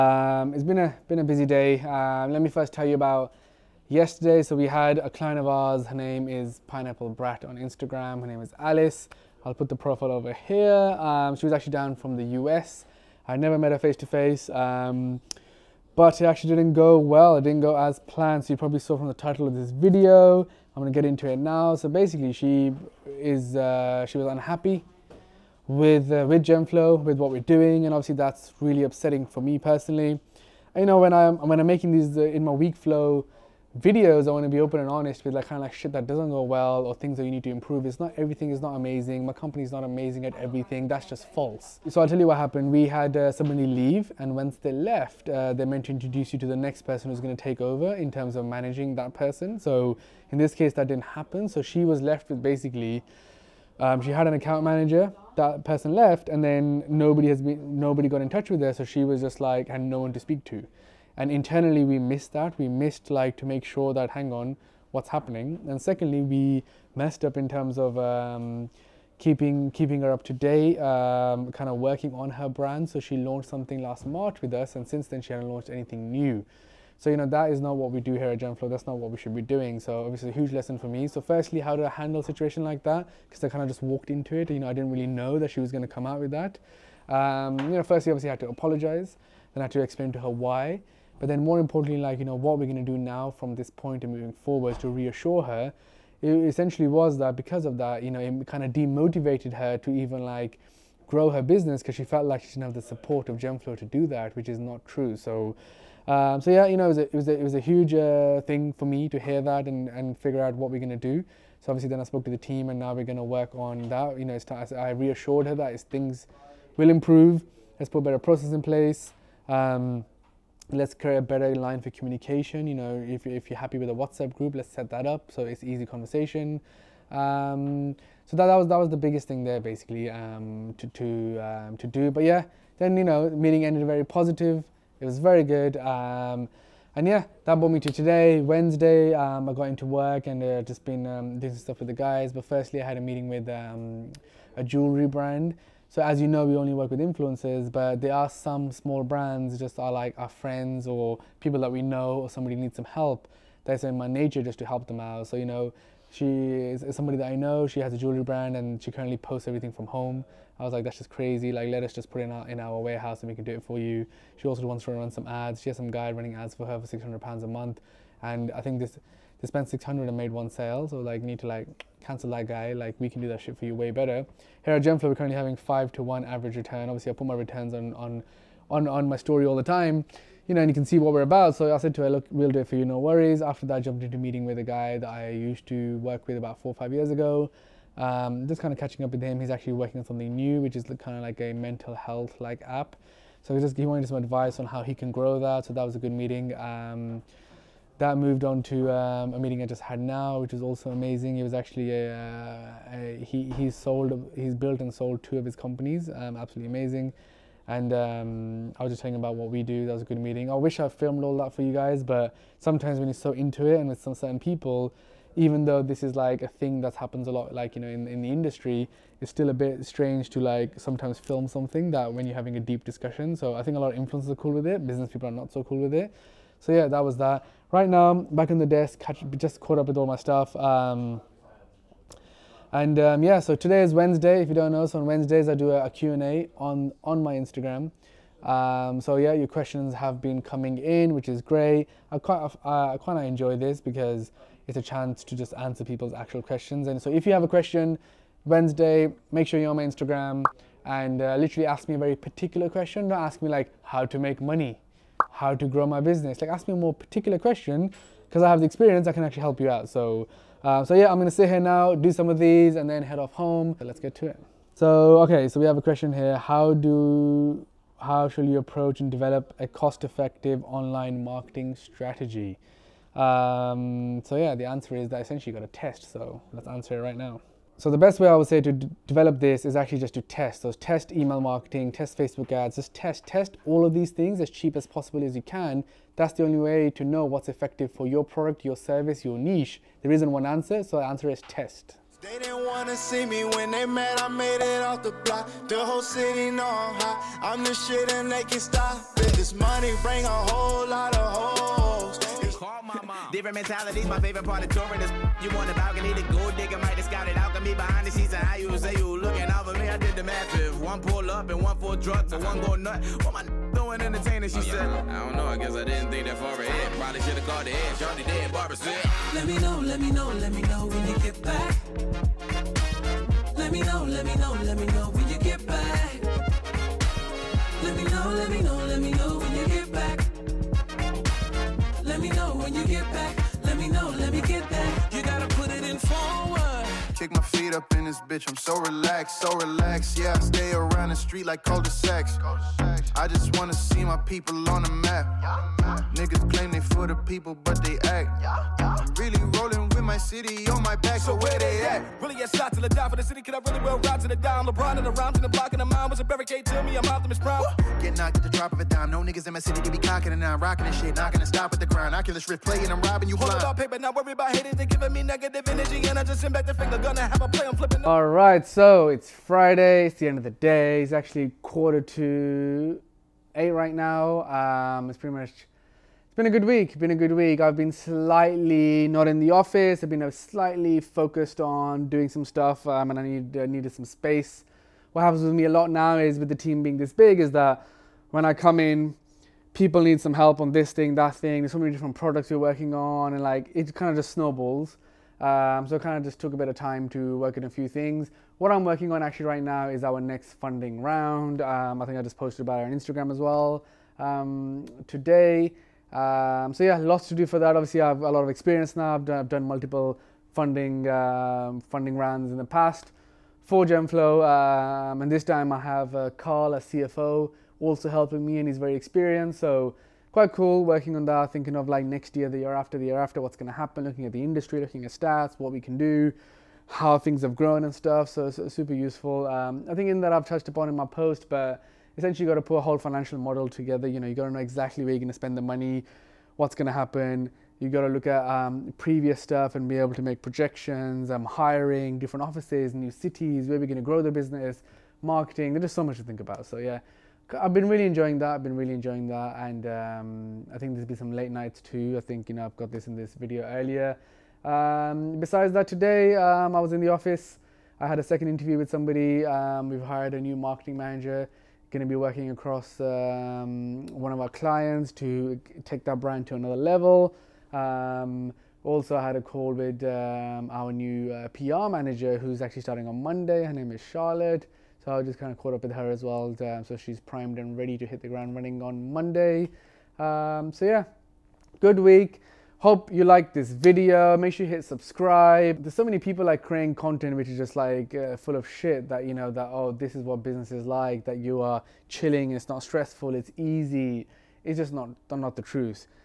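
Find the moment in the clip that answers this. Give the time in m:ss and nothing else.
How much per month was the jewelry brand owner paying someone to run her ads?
2:46.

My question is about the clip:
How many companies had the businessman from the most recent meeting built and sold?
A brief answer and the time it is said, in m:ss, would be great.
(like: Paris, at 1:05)
2, at 3:25.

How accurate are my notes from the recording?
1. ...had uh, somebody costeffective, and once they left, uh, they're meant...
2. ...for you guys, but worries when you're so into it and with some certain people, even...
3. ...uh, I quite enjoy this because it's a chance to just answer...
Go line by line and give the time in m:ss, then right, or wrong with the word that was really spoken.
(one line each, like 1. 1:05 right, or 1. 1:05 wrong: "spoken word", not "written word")
1. 0:42 wrong: "leave", not "costeffective"
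2. 3:31 wrong: "sometimes", not "worries"
3. 4:02 right.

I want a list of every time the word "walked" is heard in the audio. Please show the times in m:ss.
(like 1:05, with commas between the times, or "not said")
1:23.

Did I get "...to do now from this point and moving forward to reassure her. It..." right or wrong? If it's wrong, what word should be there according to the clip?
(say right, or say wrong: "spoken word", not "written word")
right.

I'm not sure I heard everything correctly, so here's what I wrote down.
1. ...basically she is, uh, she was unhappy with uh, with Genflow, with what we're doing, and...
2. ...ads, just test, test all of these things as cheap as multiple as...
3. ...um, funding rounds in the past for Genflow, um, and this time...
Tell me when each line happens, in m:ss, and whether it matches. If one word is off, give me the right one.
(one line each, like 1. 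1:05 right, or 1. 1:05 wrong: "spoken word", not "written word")
1. 0:21 right
2. 4:42 wrong: "possible", not "multiple"
3. 6:51 right.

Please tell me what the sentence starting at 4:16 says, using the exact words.
Like ask me a more particular question because I have the experience, I can actually help you out.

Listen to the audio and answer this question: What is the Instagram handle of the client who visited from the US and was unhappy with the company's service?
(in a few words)
Pineapple Brat.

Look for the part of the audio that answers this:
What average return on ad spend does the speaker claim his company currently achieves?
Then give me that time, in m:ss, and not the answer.
2:55.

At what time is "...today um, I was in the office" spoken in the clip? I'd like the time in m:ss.
7:35.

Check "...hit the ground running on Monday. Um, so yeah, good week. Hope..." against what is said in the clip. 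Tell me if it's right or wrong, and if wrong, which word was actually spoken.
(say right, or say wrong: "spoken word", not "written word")
right.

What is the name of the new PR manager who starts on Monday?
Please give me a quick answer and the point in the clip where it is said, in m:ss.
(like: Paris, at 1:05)
Charlotte, at 7:53.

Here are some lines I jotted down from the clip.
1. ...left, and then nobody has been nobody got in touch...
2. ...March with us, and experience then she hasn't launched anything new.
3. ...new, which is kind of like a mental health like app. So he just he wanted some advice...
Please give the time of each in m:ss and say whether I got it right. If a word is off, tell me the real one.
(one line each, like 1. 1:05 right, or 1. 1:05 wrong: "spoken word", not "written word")
1. 0:55 right
2. 1:14 wrong: "since", not "experience"
3. 3:10 right.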